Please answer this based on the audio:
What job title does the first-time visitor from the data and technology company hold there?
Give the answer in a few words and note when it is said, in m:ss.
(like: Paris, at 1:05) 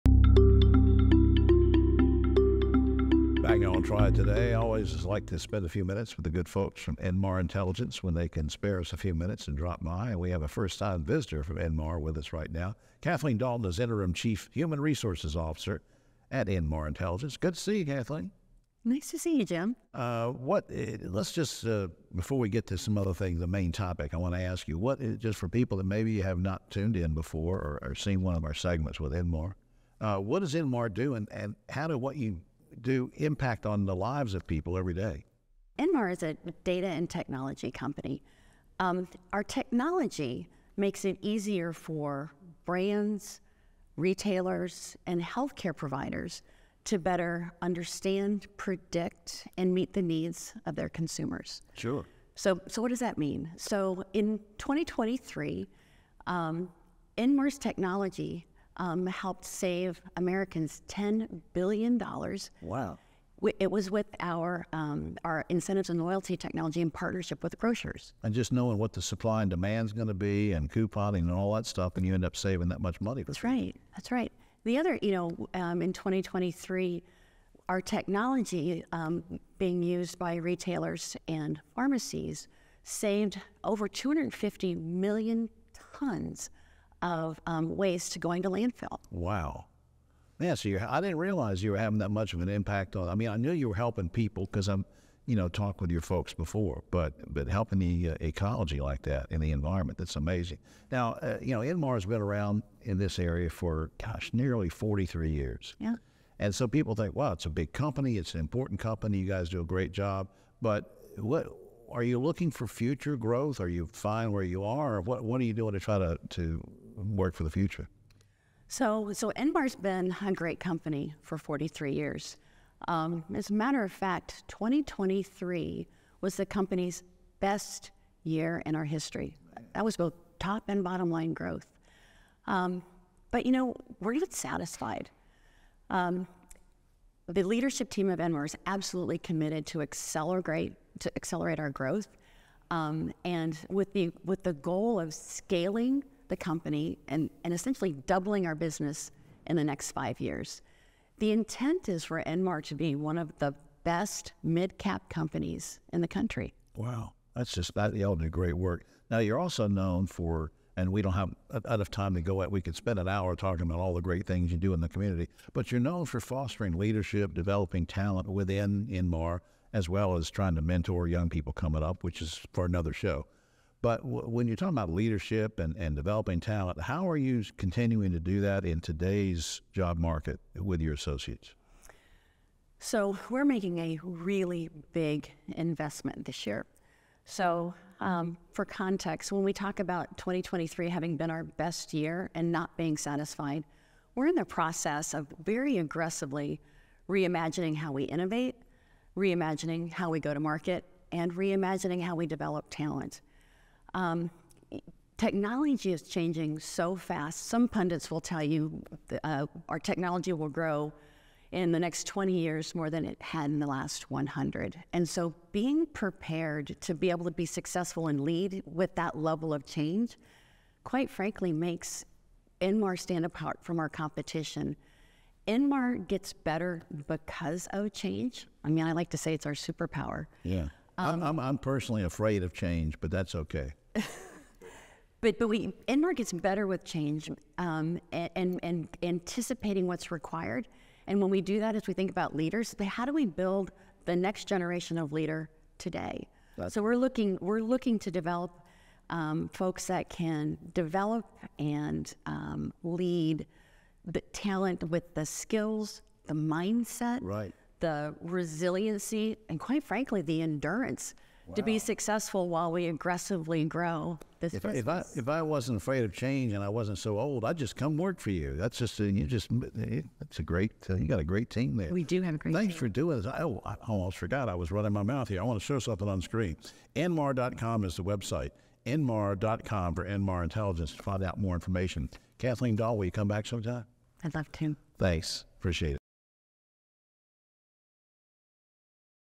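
Interim Chief Human Resources Officer, at 0:13.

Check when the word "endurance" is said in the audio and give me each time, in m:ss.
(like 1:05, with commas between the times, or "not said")
4:20.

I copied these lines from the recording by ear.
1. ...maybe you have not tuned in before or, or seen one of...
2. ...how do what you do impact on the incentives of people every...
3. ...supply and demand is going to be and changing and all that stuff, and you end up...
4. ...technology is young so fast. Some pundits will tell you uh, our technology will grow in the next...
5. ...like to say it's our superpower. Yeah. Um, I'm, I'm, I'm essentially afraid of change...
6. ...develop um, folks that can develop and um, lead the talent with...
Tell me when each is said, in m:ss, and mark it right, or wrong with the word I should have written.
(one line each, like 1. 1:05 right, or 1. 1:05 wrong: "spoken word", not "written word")
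1. 0:25 right
2. 0:31 wrong: "lives", not "incentives"
3. 1:09 wrong: "couponing", not "changing"
4. 3:25 wrong: "changing", not "young"
5. 3:48 wrong: "personally", not "essentially"
6. 4:08 right.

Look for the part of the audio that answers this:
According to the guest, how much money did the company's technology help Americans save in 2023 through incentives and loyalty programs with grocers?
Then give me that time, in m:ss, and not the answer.
1:00.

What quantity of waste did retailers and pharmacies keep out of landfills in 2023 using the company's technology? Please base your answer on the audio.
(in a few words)
250 million tons.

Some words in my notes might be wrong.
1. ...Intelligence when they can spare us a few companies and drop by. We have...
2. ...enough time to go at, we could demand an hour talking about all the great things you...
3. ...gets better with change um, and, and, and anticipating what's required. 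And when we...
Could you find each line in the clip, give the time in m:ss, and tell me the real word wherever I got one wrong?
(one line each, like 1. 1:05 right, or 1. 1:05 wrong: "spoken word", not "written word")
1. 0:07 wrong: "minutes", not "companies"
2. 2:41 wrong: "spend", not "demand"
3. 3:56 right.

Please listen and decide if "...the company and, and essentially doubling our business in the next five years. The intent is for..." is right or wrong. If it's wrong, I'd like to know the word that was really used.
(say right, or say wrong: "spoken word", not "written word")
right.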